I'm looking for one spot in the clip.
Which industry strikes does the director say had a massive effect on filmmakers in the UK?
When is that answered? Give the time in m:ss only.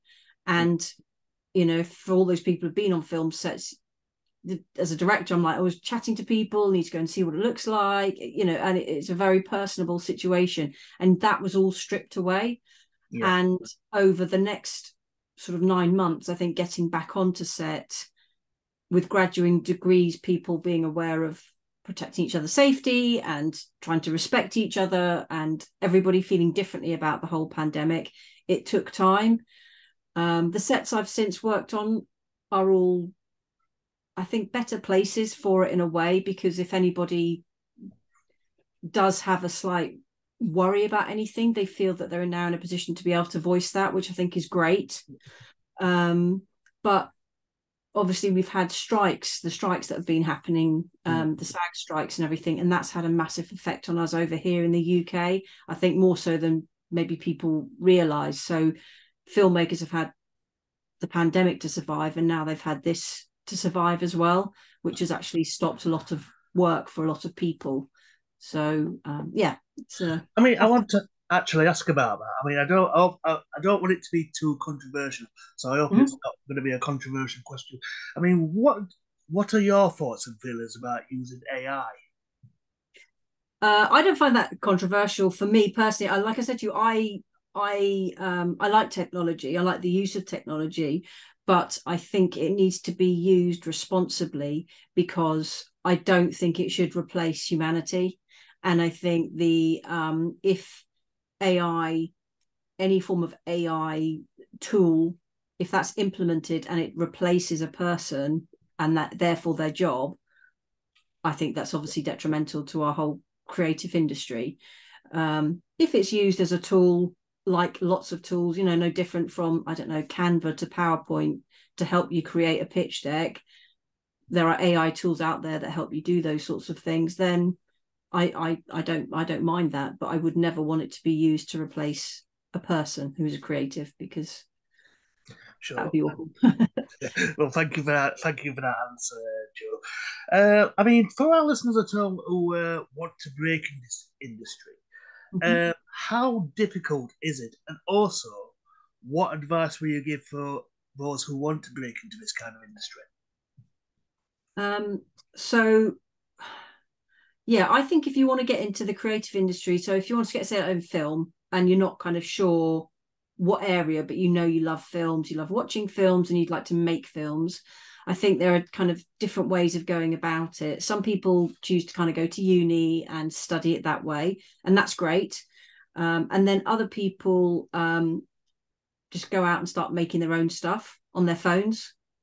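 0:51.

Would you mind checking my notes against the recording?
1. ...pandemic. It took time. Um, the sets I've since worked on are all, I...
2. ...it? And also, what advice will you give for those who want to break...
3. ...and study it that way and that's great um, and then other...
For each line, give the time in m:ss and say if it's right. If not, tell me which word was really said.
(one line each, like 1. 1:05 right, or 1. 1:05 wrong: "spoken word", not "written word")
1. 0:27 right
2. 2:27 right
3. 2:53 right.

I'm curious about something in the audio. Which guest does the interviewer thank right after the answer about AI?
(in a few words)
Jo.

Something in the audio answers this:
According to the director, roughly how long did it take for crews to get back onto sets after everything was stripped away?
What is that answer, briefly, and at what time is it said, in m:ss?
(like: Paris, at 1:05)
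9 months, at 0:15.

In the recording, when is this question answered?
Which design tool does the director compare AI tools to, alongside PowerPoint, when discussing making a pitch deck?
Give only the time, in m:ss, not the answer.
2:00.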